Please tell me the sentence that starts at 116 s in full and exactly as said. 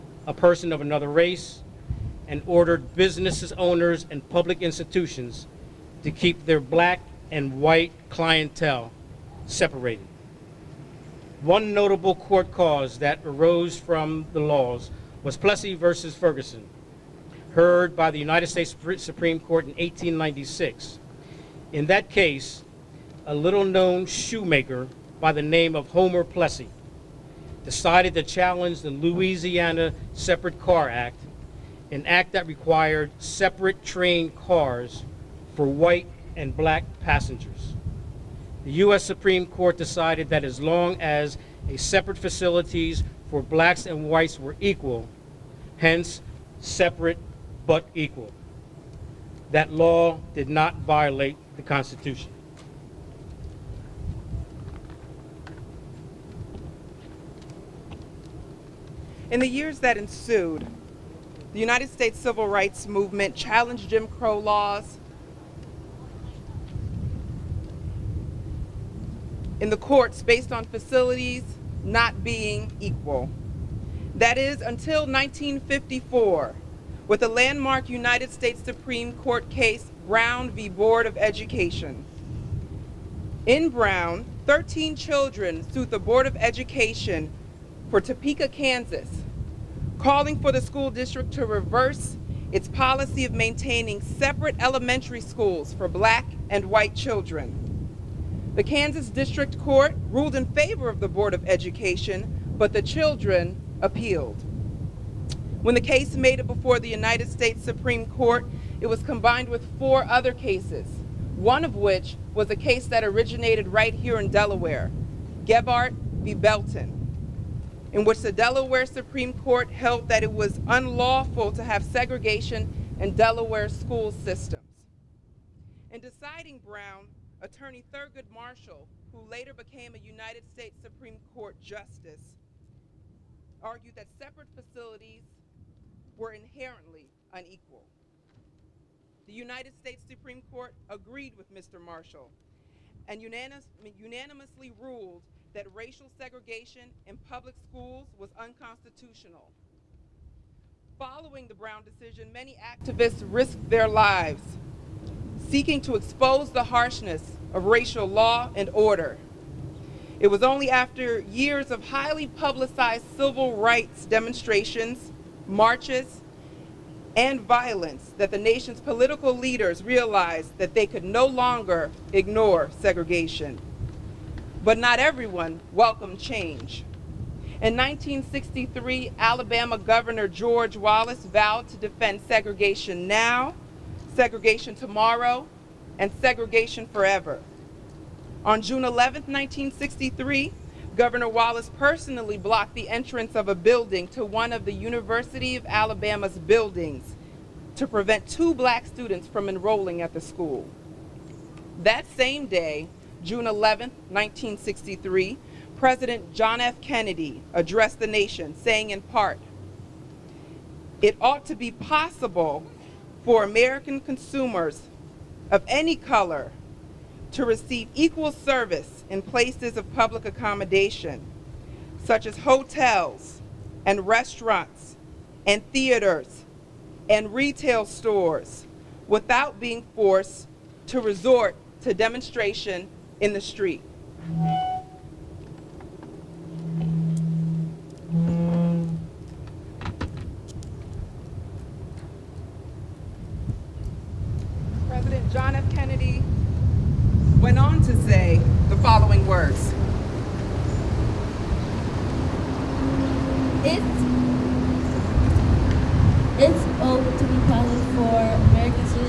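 Belton, in which the Delaware Supreme Court held that it was unlawful to have segregation in Delaware school systems.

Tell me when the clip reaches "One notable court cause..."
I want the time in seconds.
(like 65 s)
11 s.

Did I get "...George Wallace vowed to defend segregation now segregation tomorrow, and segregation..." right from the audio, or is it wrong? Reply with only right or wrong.
right.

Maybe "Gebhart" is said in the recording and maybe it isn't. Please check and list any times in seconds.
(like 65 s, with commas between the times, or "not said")
115 s.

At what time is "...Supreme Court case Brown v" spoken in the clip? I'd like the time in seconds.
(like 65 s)
78 s.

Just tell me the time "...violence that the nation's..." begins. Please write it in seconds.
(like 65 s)
167 s.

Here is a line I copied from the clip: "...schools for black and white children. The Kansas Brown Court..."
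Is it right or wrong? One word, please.
wrong.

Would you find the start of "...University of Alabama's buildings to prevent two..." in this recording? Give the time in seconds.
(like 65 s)
194 s.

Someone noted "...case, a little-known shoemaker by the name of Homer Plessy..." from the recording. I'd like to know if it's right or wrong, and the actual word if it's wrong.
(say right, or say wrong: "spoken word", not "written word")
right.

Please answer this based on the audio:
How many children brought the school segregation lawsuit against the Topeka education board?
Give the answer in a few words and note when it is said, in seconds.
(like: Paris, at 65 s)
13, at 84 s.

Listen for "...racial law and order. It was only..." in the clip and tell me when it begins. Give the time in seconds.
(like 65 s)
157 s.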